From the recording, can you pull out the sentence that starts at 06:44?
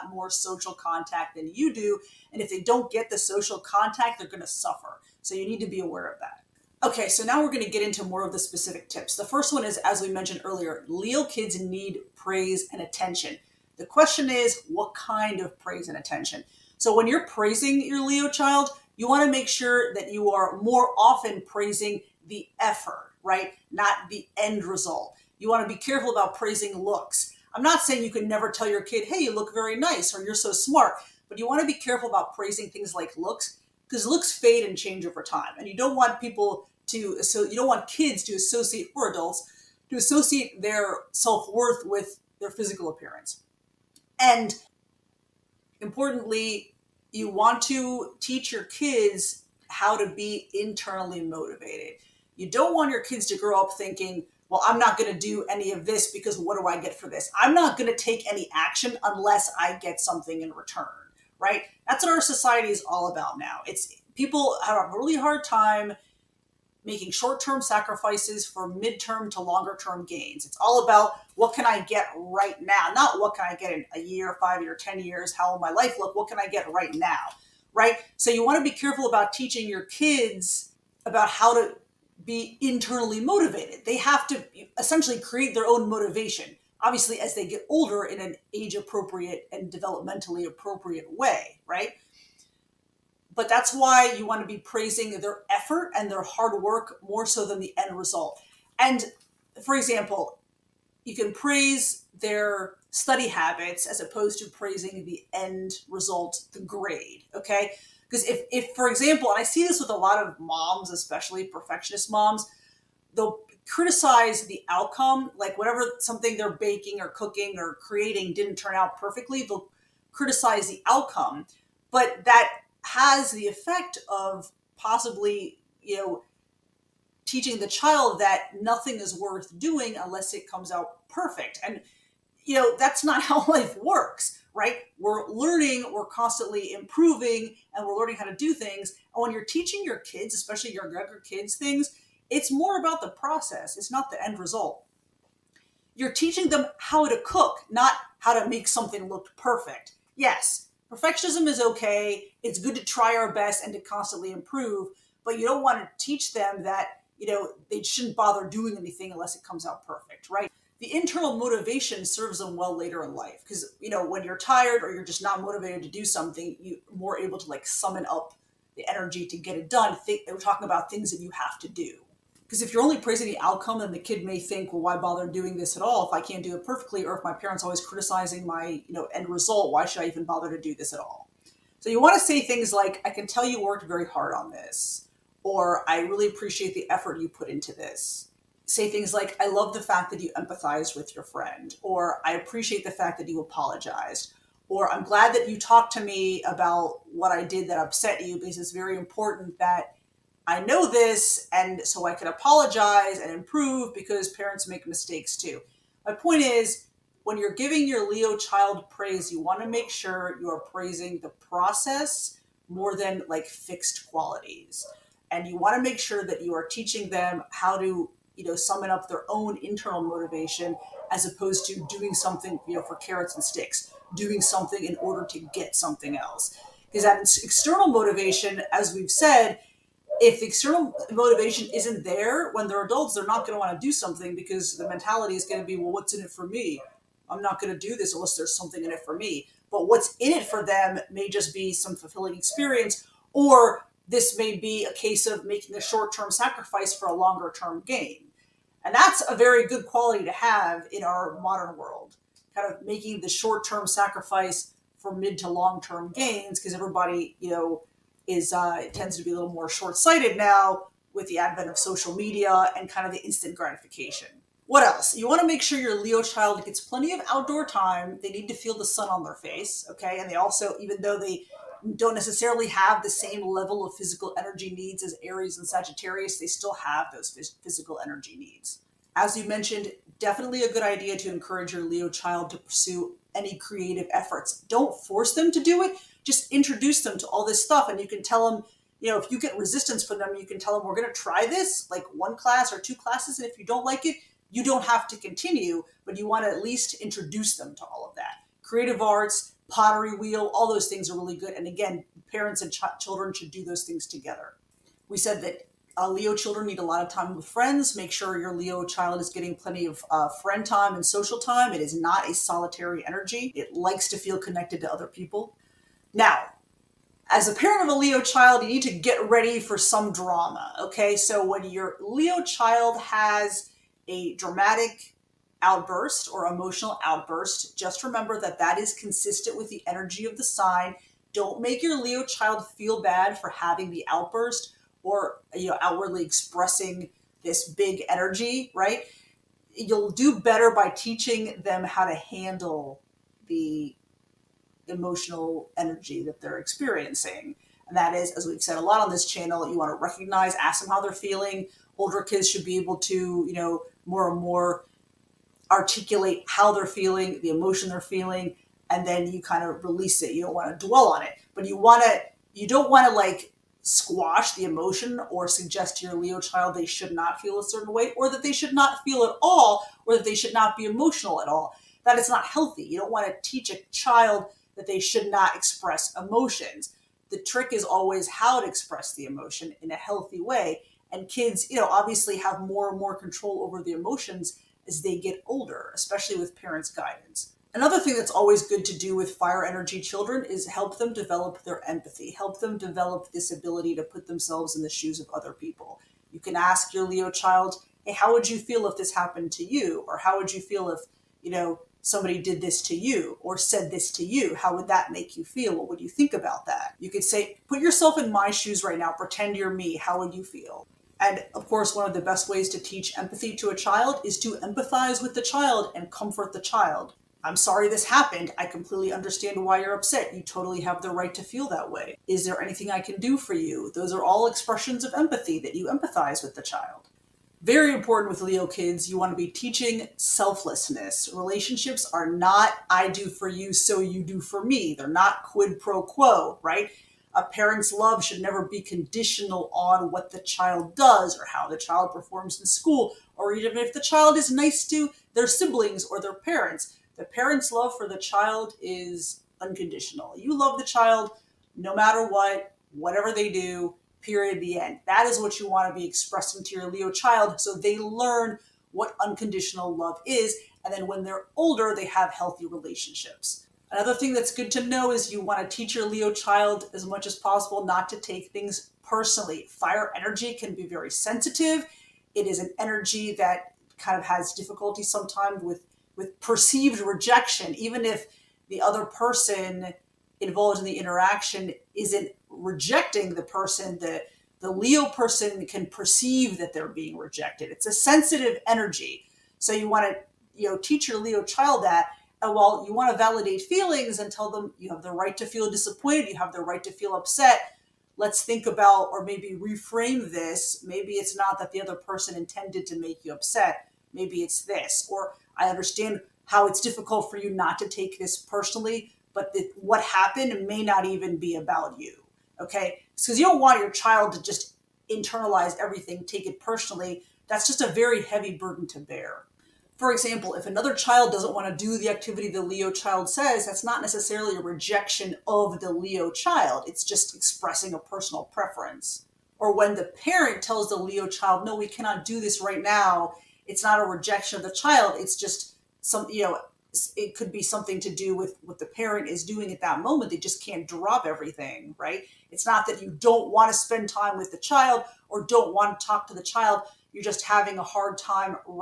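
How would that make you feel?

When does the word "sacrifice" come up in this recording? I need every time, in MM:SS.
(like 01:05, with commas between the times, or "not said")
01:07, 04:06, 04:13.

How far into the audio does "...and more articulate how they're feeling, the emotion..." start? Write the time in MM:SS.
05:54.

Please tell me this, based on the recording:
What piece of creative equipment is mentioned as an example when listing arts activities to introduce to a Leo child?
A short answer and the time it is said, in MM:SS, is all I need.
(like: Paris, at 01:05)
pottery wheel, at 04:59.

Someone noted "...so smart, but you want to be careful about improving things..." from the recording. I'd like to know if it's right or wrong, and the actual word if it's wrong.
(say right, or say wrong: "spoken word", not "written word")
wrong: "praising", not "improving".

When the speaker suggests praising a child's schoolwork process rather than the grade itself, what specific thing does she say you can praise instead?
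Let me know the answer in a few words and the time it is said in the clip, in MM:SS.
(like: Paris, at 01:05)
study habits, at 01:42.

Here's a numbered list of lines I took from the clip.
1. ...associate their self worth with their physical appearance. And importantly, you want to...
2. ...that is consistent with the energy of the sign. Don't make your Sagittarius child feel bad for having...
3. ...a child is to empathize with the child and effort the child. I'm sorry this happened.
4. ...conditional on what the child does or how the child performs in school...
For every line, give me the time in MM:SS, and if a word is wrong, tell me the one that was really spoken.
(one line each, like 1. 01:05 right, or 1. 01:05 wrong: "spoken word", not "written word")
1. 00:39 right
2. 05:28 wrong: "Leo", not "Sagittarius"
3. 06:53 wrong: "comfort", not "effort"
4. 07:18 right.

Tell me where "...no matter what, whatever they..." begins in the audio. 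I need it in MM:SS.
07:31.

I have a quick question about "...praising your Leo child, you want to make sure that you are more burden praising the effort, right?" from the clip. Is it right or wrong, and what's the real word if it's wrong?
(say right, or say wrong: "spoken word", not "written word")
wrong: "often", not "burden".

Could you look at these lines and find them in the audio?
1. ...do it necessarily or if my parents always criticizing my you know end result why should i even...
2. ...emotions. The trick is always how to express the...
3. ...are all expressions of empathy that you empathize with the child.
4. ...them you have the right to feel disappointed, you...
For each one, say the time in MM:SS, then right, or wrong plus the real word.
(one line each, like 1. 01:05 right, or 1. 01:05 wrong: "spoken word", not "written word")
1. 02:56 wrong: "perfectly", not "necessarily"
2. 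06:16 right
3. 07:04 right
4. 08:14 right.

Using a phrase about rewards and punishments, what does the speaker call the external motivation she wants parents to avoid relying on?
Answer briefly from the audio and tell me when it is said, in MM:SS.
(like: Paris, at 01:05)
carrots and sticks, at 03:42.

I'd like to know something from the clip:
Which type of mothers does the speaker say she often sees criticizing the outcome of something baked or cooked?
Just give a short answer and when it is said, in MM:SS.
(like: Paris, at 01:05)
perfectionist moms, at 01:51.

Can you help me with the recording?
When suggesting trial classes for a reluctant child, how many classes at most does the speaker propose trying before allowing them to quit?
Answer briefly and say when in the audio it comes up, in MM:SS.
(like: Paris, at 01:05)
2, at 04:52.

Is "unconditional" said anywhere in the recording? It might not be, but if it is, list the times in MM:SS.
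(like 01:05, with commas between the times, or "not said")
07:29, 07:39.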